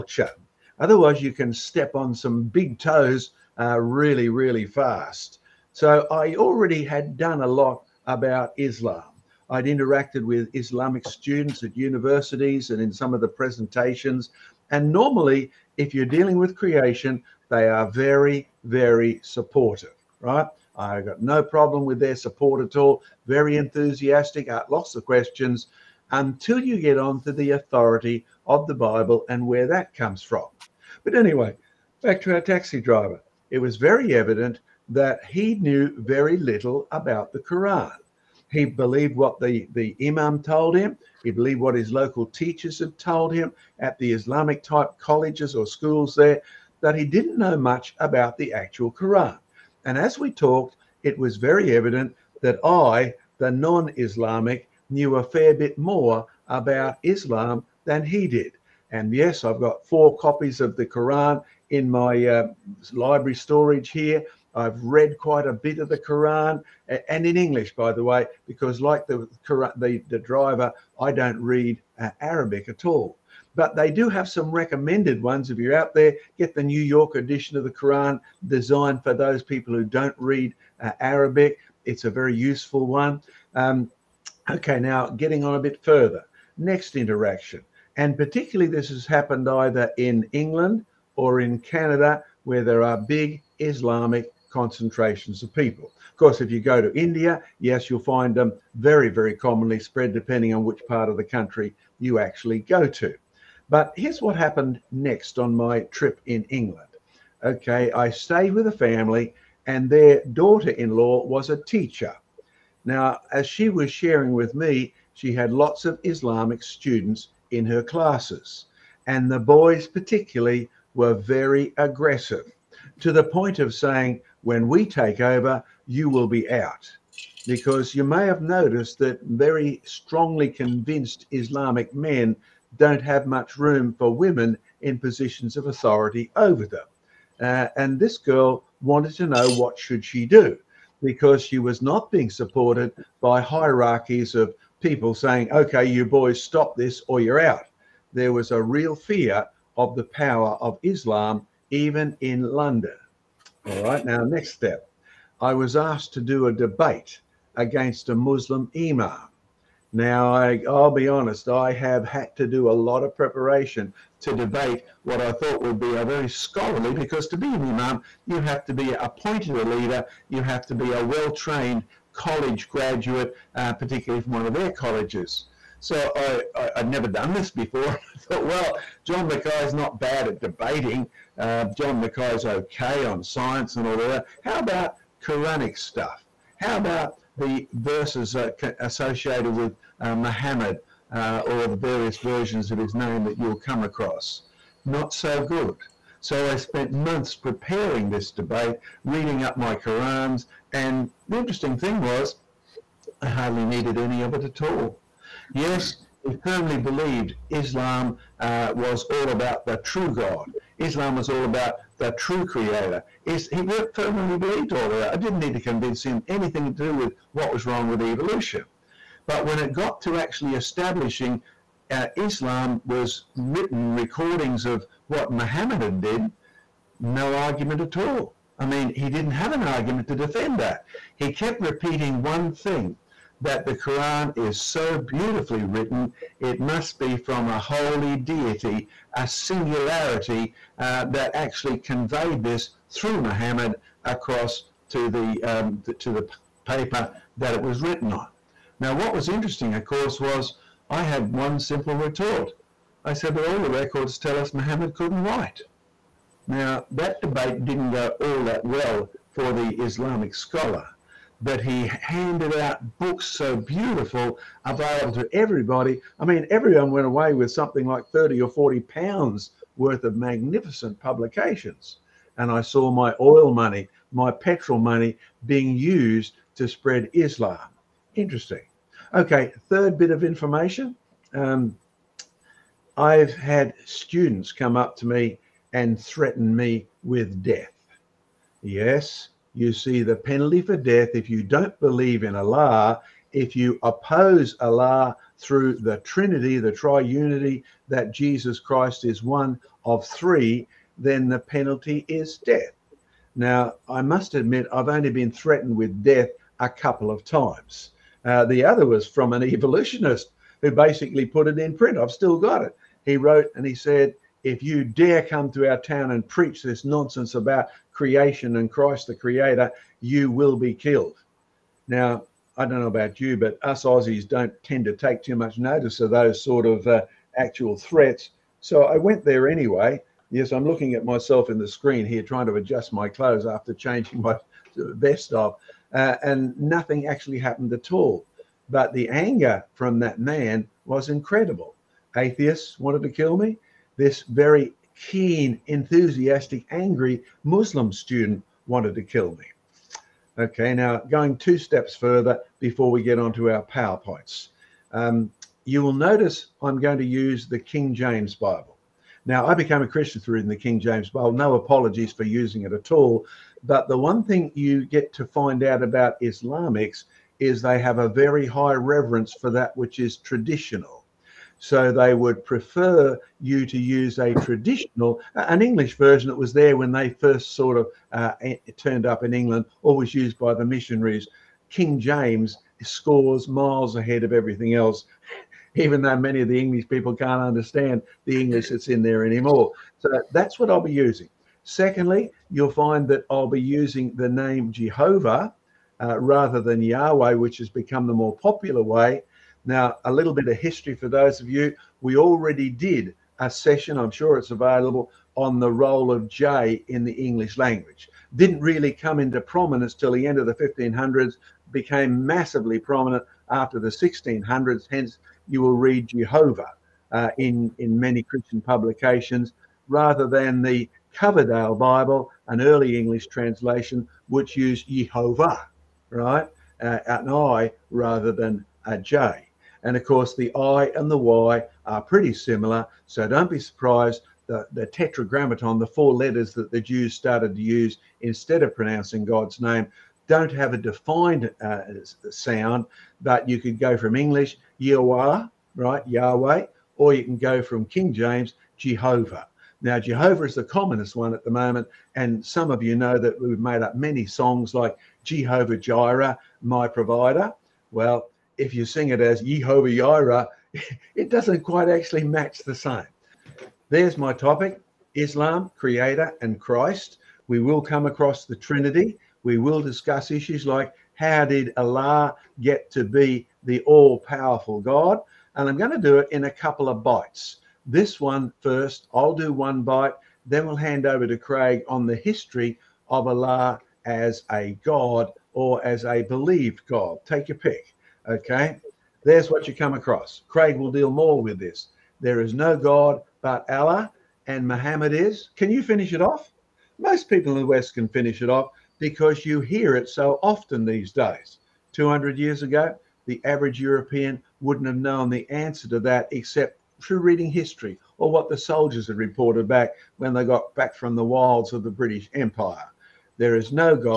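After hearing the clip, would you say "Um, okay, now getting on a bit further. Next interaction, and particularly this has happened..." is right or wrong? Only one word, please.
right.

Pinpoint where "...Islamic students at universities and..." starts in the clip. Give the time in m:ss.
0:10.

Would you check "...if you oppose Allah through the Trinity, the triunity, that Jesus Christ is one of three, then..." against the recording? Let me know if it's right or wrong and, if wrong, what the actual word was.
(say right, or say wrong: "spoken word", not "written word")
right.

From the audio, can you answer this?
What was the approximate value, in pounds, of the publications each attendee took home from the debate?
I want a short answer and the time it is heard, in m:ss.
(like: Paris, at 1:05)
30 or 40 pounds, at 4:28.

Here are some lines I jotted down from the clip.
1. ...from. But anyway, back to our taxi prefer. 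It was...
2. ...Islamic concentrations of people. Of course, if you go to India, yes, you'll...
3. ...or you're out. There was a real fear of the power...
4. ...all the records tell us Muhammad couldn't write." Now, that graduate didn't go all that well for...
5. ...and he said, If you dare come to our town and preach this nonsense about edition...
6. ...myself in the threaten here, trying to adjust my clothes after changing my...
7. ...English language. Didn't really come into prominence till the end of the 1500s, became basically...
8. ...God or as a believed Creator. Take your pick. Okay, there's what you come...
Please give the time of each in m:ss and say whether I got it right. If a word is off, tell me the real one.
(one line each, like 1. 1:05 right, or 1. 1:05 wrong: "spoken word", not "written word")
1. 0:30 wrong: "driver", not "prefer"
2. 1:33 right
3. 2:27 right
4. 4:13 wrong: "debate", not "graduate"
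5. 5:13 wrong: "creation", not "edition"
6. 5:31 wrong: "screen", not "threaten"
7. 6:47 wrong: "massively", not "basically"
8. 8:04 wrong: "God", not "Creator".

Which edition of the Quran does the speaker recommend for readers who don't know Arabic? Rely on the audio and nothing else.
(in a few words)
New York edition.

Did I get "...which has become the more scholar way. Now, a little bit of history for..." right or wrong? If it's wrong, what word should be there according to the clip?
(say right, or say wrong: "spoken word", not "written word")
wrong: "popular", not "scholar".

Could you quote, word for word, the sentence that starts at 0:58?
And yes, I've got four copies of the Quran in my uh, library storage here.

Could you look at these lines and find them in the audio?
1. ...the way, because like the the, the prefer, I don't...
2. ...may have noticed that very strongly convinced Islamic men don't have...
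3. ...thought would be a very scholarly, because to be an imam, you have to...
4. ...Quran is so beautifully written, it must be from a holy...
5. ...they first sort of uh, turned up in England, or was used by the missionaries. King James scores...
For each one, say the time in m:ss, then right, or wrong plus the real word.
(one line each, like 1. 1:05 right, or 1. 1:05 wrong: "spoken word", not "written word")
1. 1:07 wrong: "driver", not "prefer"
2. 2:08 right
3. 2:45 right
4. 3:53 right
5. 6:16 right.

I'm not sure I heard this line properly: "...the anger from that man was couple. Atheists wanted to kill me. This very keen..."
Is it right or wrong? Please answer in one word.
wrong.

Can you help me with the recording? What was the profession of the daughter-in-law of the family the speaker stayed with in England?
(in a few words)
Teacher.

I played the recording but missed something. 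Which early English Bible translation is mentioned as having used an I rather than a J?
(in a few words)
Coverdale Bible.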